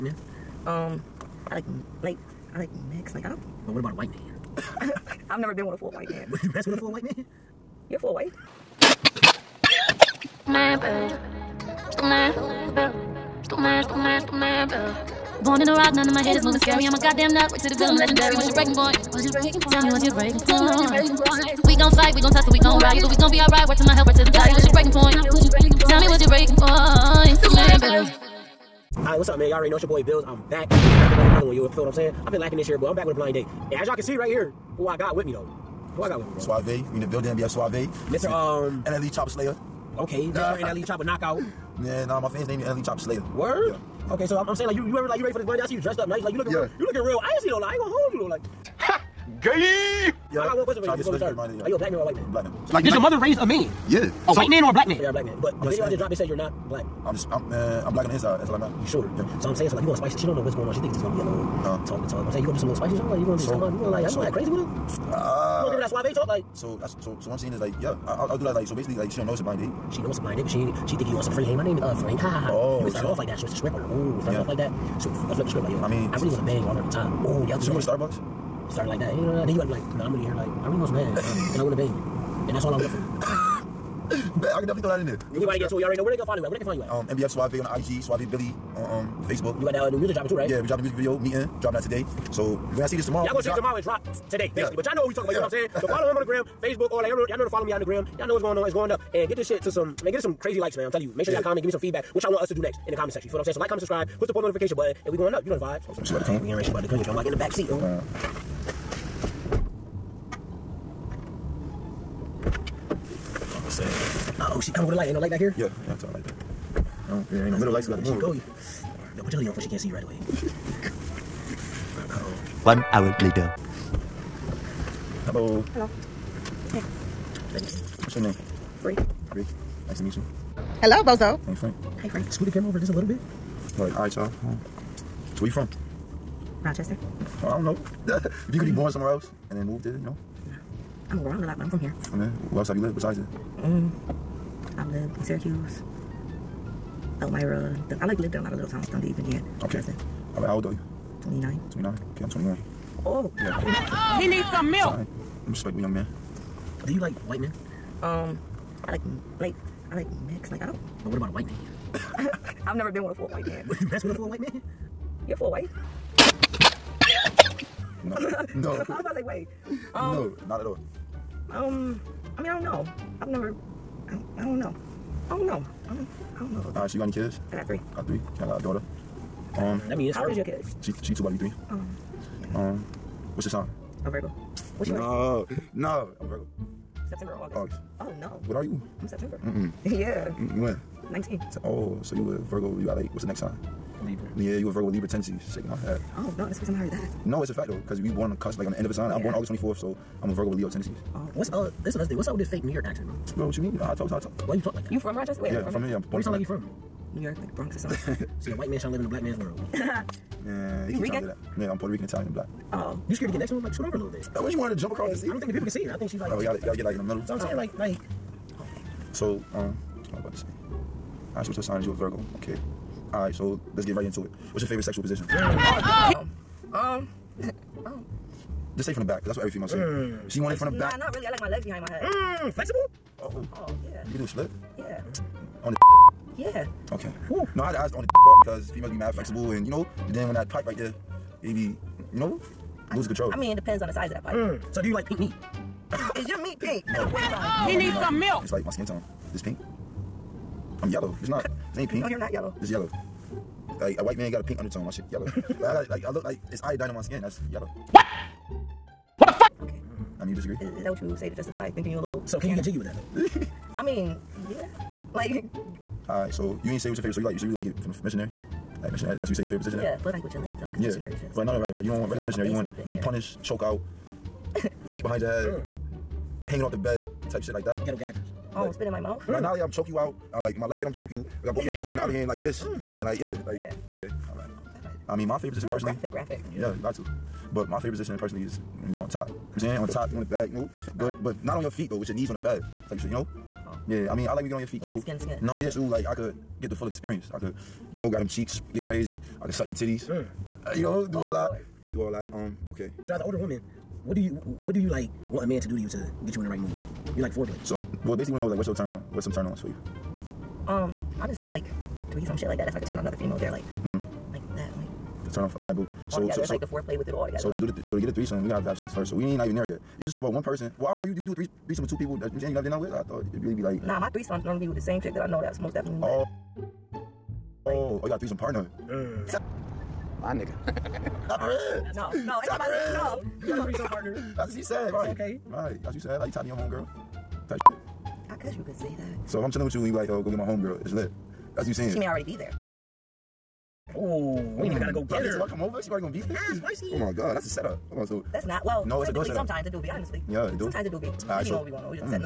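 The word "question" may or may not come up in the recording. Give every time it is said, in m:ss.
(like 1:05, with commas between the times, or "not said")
0:50.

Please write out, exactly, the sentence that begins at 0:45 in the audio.
I see you dressed up nice, like you looking yeah.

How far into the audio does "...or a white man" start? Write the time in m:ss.
0:51.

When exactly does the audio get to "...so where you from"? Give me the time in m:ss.
2:15.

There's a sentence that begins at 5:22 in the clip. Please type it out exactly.
I thought it'd really be like nah.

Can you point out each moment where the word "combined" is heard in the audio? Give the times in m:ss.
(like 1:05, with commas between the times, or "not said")
not said.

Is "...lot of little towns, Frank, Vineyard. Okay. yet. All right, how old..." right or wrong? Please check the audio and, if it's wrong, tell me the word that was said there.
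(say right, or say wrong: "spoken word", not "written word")
wrong: "Dundee", not "Frank".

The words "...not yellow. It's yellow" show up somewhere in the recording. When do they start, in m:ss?
4:12.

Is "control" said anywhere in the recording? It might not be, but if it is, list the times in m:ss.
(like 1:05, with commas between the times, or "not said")
4:03.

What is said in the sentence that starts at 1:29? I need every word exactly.
You got that uh, new music dropping too, right?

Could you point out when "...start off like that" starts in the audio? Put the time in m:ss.
1:12.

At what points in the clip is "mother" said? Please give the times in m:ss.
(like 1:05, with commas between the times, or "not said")
0:52.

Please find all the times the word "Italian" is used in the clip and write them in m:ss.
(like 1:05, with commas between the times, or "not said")
3:32.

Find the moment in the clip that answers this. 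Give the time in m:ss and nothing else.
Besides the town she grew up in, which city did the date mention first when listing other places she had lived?
2:25.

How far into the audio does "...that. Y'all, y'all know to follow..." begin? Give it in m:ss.
1:37.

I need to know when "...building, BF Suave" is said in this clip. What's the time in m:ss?
0:37.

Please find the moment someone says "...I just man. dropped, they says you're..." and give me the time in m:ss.
0:55.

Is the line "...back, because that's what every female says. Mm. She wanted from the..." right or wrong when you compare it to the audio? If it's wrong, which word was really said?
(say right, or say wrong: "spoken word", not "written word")
right.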